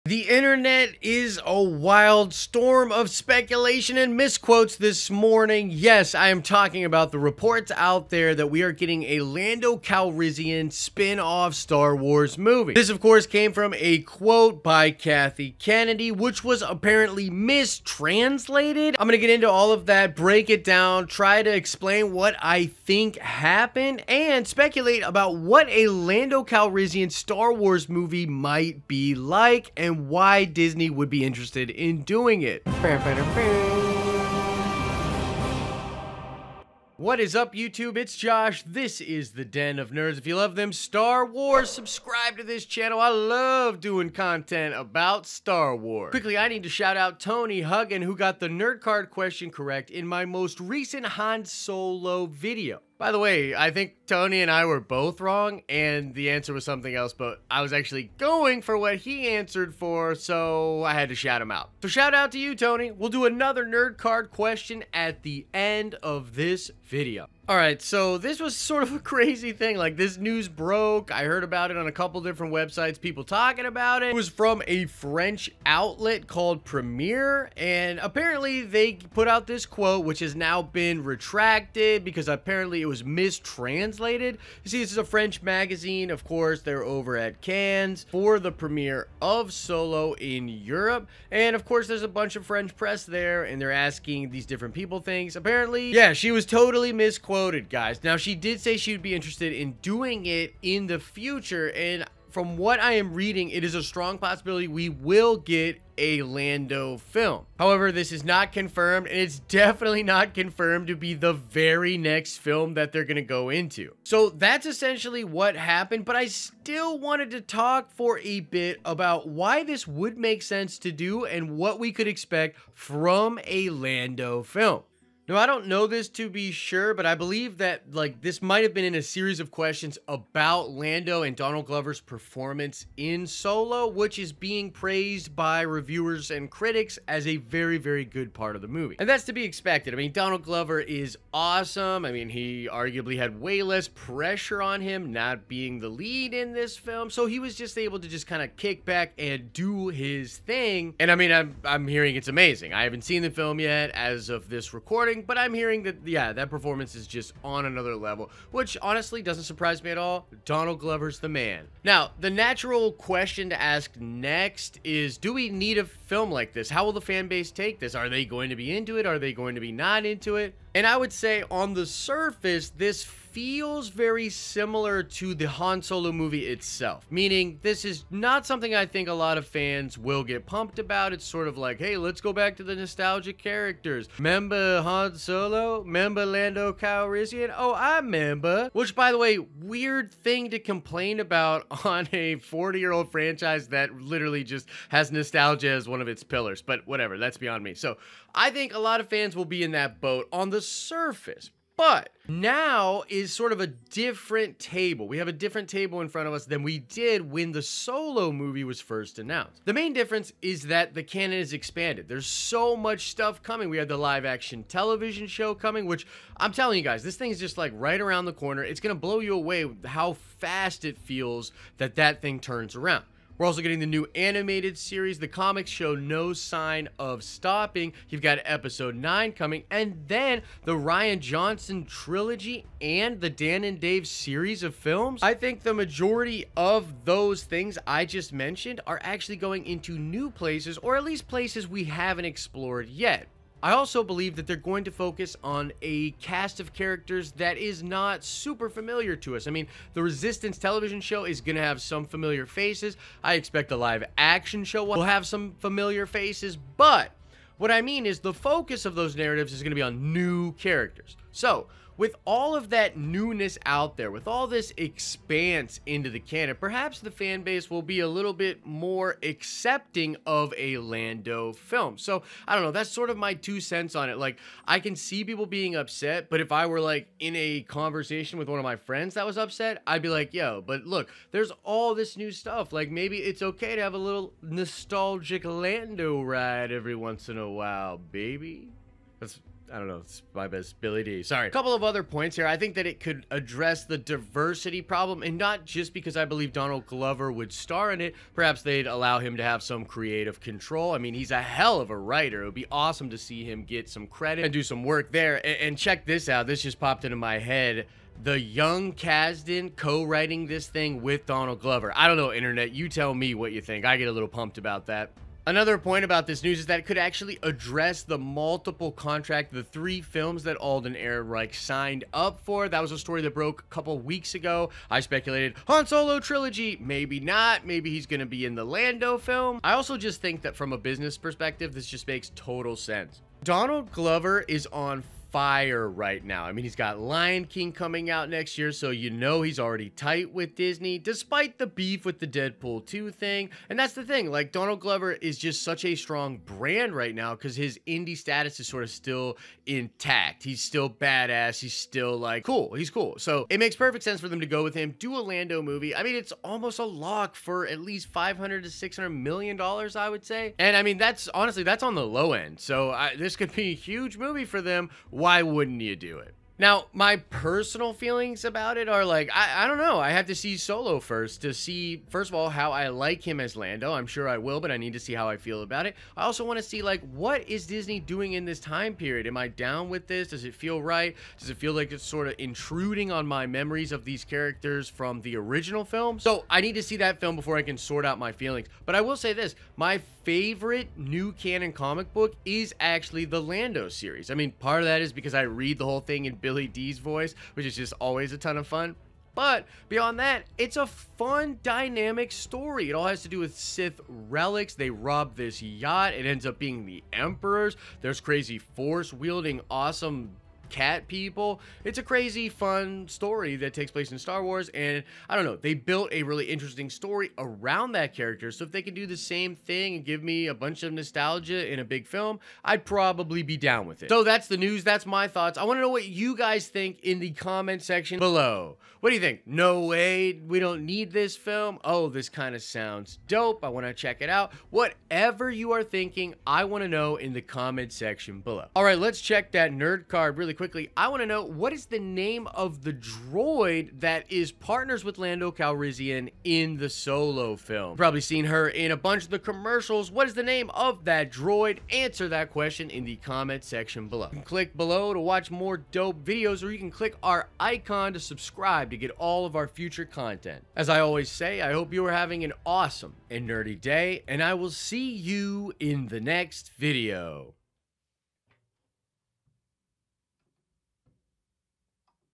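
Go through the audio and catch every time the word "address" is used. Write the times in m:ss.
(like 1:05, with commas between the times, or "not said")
4:53, 5:17.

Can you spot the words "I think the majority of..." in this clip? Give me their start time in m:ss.
3:55.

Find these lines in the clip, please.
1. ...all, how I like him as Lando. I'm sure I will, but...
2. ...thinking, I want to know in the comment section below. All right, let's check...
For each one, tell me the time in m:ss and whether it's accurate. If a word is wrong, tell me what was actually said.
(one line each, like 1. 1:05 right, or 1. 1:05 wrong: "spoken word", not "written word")
1. 6:12 right
2. 7:15 right.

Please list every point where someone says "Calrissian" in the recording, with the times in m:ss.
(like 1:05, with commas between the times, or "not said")
0:09, 0:26, 3:06, 7:25.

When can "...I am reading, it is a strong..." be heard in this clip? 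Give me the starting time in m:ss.
1:42.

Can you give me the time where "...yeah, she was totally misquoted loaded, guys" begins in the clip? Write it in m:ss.
1:35.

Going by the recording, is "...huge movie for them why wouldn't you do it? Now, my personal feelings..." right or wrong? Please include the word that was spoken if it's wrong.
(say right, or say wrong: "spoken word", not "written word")
right.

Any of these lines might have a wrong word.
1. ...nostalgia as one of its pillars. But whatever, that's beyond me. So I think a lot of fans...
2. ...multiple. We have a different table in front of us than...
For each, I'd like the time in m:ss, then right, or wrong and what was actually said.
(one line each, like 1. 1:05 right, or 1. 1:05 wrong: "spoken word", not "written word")
1. 3:15 right
2. 3:24 wrong: "table", not "multiple".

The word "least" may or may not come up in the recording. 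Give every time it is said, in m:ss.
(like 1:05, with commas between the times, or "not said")
4:01, 5:57.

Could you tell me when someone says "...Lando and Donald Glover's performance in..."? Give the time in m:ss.
2:10.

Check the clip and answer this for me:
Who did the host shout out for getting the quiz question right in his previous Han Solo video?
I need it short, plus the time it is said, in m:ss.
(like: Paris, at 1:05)
Tony Huggin, at 0:47.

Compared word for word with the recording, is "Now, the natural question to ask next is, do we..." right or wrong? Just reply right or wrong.
right.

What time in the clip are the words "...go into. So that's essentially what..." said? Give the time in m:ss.
1:53.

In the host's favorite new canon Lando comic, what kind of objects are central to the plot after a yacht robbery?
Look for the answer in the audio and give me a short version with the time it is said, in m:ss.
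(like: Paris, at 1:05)
Sith relics, at 6:43.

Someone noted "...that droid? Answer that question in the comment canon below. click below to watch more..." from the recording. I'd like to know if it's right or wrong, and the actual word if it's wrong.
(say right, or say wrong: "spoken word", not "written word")
wrong: "section", not "canon".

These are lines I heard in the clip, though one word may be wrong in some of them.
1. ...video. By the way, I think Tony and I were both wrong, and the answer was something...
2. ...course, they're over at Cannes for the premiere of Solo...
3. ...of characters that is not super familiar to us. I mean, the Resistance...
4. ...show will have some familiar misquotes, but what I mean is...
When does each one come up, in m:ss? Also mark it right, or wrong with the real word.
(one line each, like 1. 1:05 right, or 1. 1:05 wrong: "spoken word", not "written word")
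1. 0:52 right
2. 1:26 right
3. 4:06 right
4. 4:14 wrong: "faces", not "misquotes".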